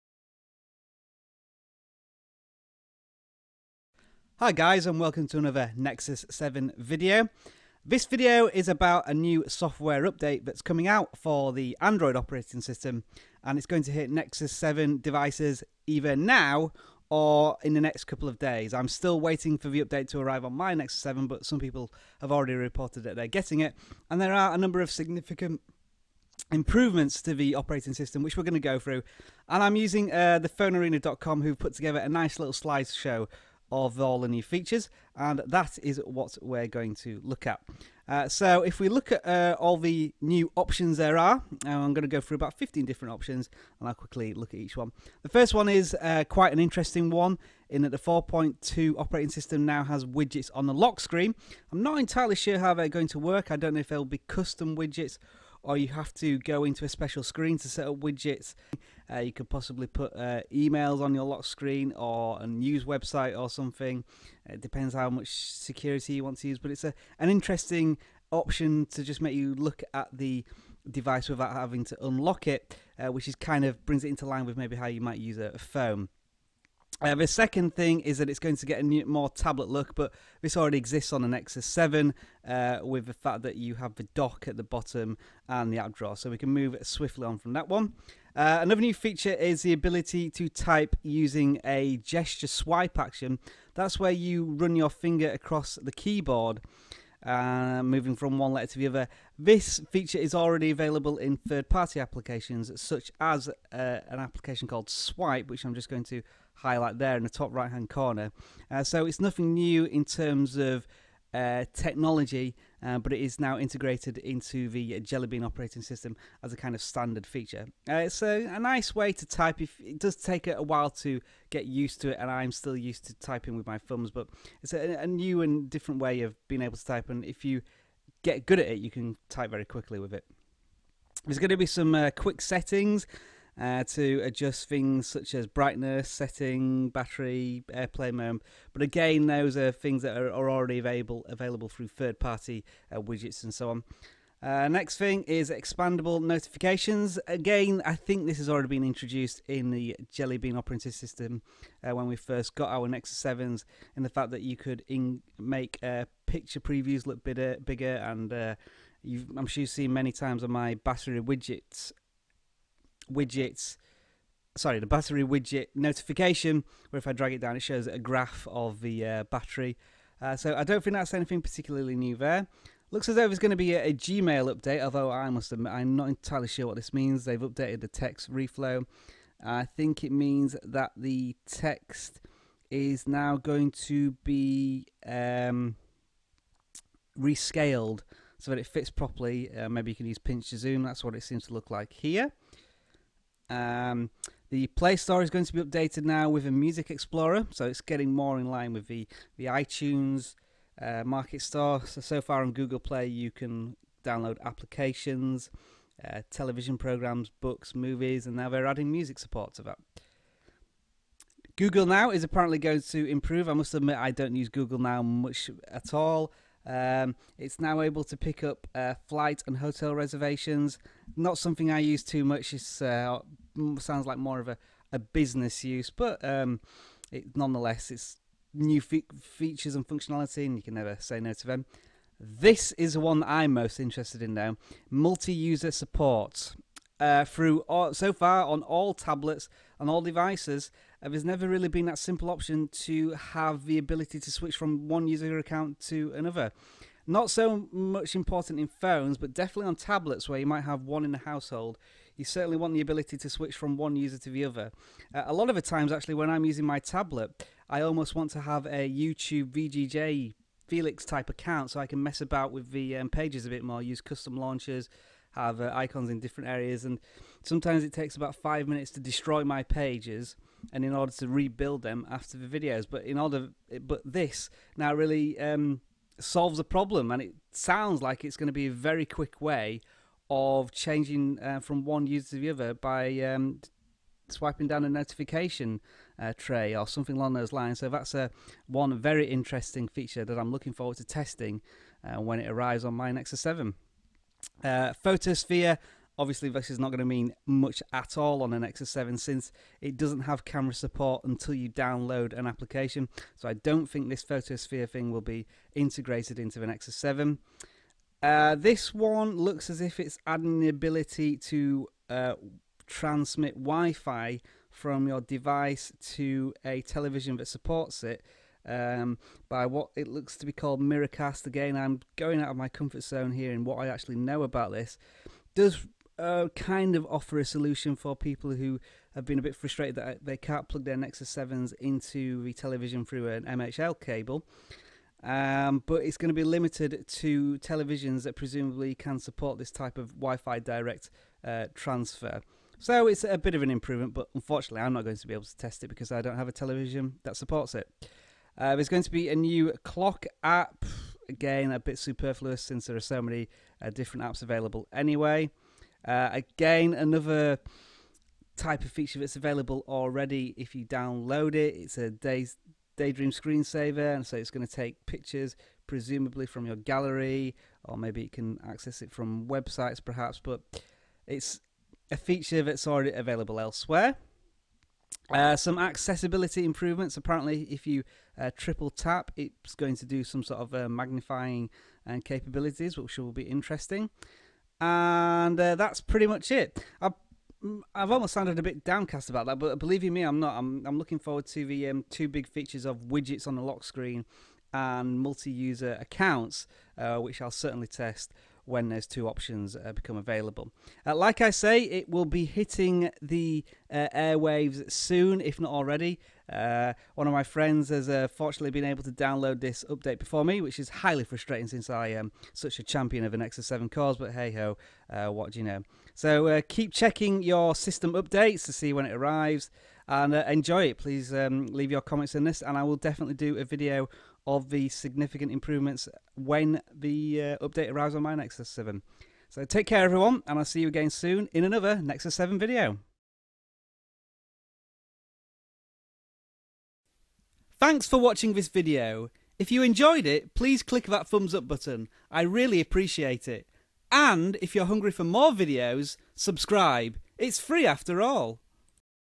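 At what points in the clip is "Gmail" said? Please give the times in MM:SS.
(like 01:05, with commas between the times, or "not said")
02:53.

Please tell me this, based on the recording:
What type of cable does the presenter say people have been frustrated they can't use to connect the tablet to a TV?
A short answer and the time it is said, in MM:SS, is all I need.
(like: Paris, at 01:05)
MHL cable, at 05:33.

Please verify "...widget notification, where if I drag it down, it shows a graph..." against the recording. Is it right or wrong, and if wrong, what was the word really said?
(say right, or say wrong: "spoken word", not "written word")
right.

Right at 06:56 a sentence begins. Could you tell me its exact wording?
So keep checking your system updates to see when it arrives and enjoy it.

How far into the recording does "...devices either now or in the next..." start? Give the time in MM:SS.
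00:14.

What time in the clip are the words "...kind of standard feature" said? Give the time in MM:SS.
01:56.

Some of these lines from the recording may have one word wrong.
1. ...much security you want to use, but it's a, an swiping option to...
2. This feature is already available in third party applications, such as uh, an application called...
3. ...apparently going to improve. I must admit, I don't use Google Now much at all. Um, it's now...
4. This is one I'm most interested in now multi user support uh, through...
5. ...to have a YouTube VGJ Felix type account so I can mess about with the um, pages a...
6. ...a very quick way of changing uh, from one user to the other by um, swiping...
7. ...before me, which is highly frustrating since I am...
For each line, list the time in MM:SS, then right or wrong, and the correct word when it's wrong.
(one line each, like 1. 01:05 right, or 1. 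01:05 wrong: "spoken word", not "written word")
1. 01:05 wrong: "interesting", not "swiping"
2. 01:39 right
3. 03:32 right
4. 03:52 right
5. 04:18 right
6. 04:38 right
7. 06:50 right.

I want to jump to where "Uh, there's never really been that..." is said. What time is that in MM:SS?
04:01.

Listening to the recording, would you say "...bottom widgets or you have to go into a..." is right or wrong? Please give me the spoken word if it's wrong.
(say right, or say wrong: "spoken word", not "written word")
wrong: "custom", not "bottom".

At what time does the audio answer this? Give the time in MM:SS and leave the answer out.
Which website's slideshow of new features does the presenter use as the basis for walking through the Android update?
00:30.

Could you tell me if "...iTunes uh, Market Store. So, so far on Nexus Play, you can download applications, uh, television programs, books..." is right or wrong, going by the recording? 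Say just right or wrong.
wrong.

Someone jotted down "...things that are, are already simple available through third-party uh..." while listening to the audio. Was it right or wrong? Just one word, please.
wrong.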